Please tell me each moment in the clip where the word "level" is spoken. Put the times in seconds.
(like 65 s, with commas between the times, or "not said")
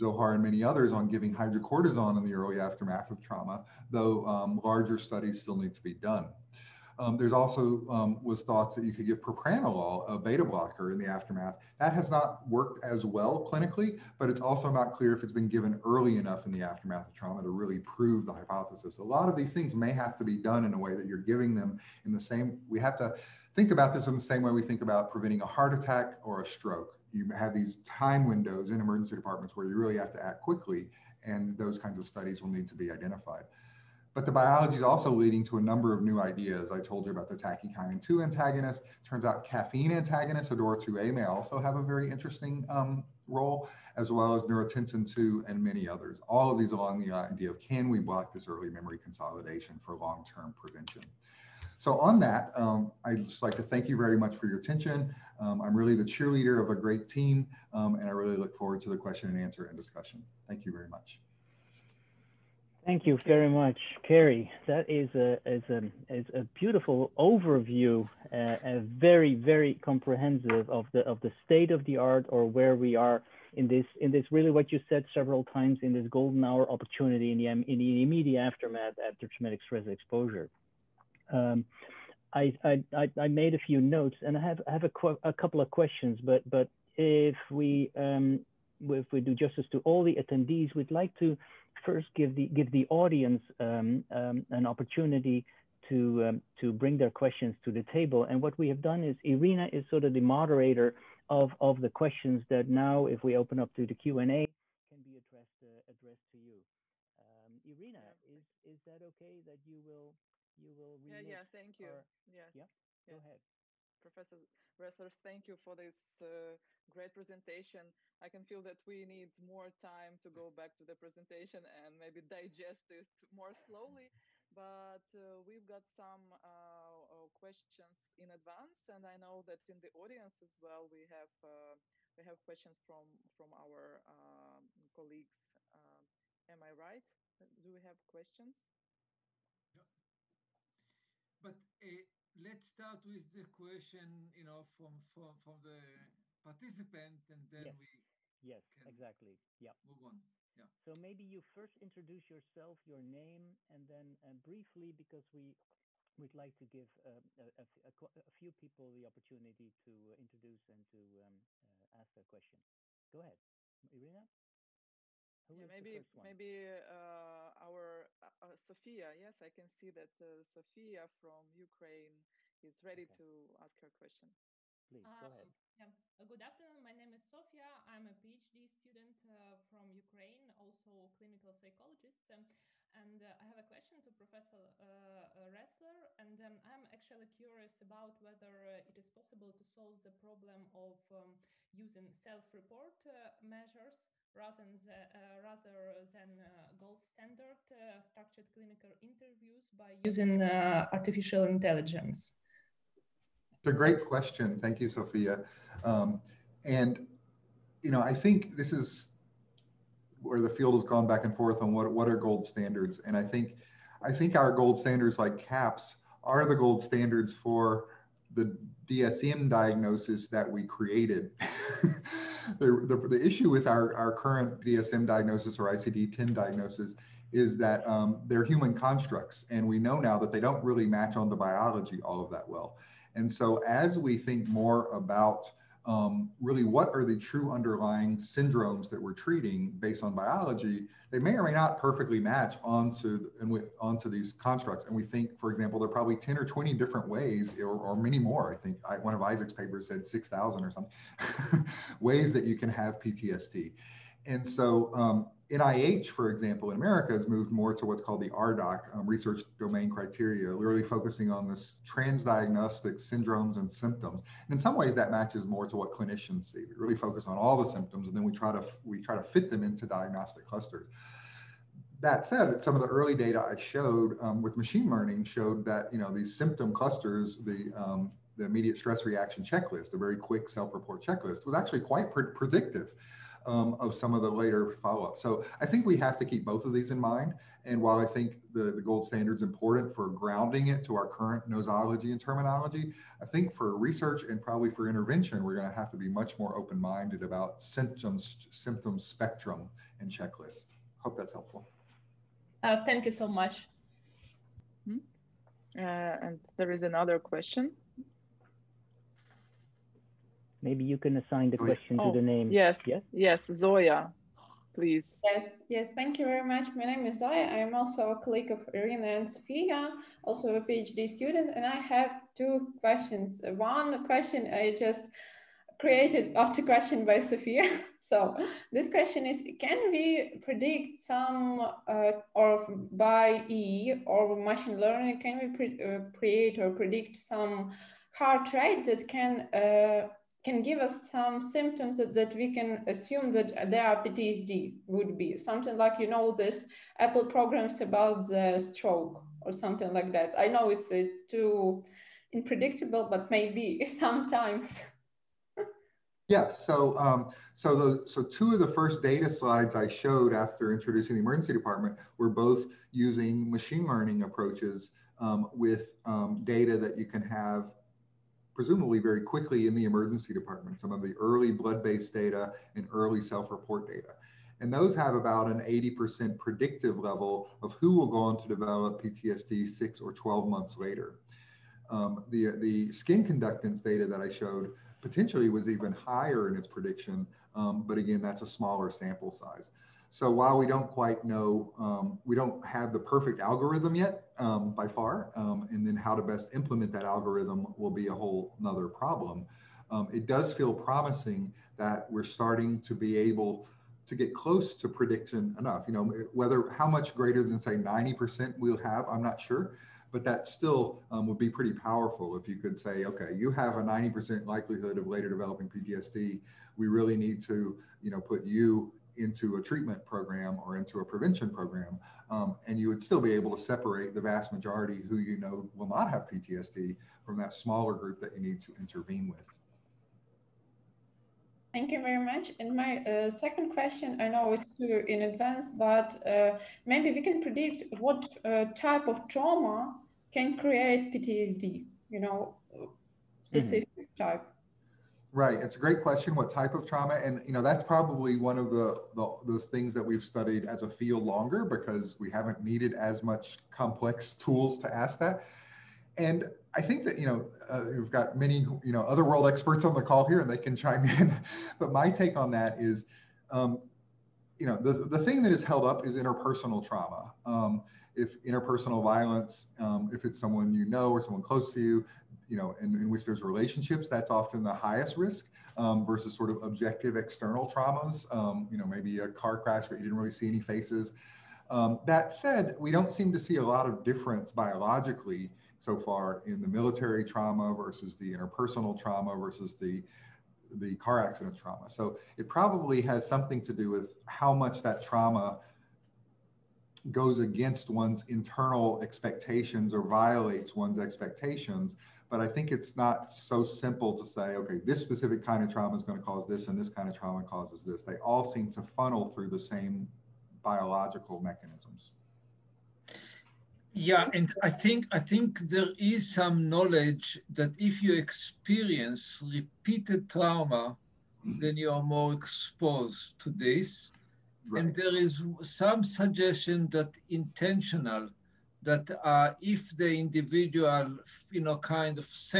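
376 s.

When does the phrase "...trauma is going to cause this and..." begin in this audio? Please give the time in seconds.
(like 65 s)
505 s.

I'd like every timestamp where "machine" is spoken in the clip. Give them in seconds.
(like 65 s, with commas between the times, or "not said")
274 s, 334 s, 363 s.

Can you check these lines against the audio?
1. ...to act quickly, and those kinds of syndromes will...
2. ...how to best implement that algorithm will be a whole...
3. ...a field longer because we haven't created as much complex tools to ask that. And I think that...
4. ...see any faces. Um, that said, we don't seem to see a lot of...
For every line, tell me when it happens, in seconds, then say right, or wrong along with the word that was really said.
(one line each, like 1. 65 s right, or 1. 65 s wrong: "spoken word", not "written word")
1. 30 s wrong: "studies", not "syndromes"
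2. 395 s right
3. 450 s wrong: "needed", not "created"
4. 480 s right.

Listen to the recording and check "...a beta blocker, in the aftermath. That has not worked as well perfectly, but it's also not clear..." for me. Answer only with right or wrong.
wrong.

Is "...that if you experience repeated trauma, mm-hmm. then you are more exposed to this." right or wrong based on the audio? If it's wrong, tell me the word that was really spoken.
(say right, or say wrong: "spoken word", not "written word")
right.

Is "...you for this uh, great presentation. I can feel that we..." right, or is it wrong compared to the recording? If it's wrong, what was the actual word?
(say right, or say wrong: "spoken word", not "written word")
right.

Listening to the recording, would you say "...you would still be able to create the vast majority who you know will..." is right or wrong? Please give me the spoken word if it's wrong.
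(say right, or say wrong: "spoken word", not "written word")
wrong: "separate", not "create".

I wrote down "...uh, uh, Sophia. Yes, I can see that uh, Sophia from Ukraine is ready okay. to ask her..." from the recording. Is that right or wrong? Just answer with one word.
right.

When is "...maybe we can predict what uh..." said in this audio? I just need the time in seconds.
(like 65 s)
436 s.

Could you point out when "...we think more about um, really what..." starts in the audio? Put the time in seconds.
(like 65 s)
233 s.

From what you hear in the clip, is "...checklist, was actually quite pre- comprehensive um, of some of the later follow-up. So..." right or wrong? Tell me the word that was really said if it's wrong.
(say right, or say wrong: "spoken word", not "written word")
wrong: "predictive", not "comprehensive".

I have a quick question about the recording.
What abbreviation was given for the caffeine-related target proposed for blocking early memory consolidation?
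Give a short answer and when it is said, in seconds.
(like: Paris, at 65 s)
ADOR2A, at 40 s.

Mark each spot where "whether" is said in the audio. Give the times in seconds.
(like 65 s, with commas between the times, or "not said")
188 s, 406 s.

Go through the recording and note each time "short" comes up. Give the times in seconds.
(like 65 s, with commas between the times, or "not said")
not said.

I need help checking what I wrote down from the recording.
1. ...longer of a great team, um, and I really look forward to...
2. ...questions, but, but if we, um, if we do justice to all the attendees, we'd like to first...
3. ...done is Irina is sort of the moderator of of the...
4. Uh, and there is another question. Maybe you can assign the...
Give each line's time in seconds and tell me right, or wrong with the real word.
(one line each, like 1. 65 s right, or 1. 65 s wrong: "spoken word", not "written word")
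1. 56 s wrong: "cheerleader", not "longer"
2. 85 s right
3. 98 s right
4. 305 s right.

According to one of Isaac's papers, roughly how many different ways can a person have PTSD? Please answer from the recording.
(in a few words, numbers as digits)
6,000.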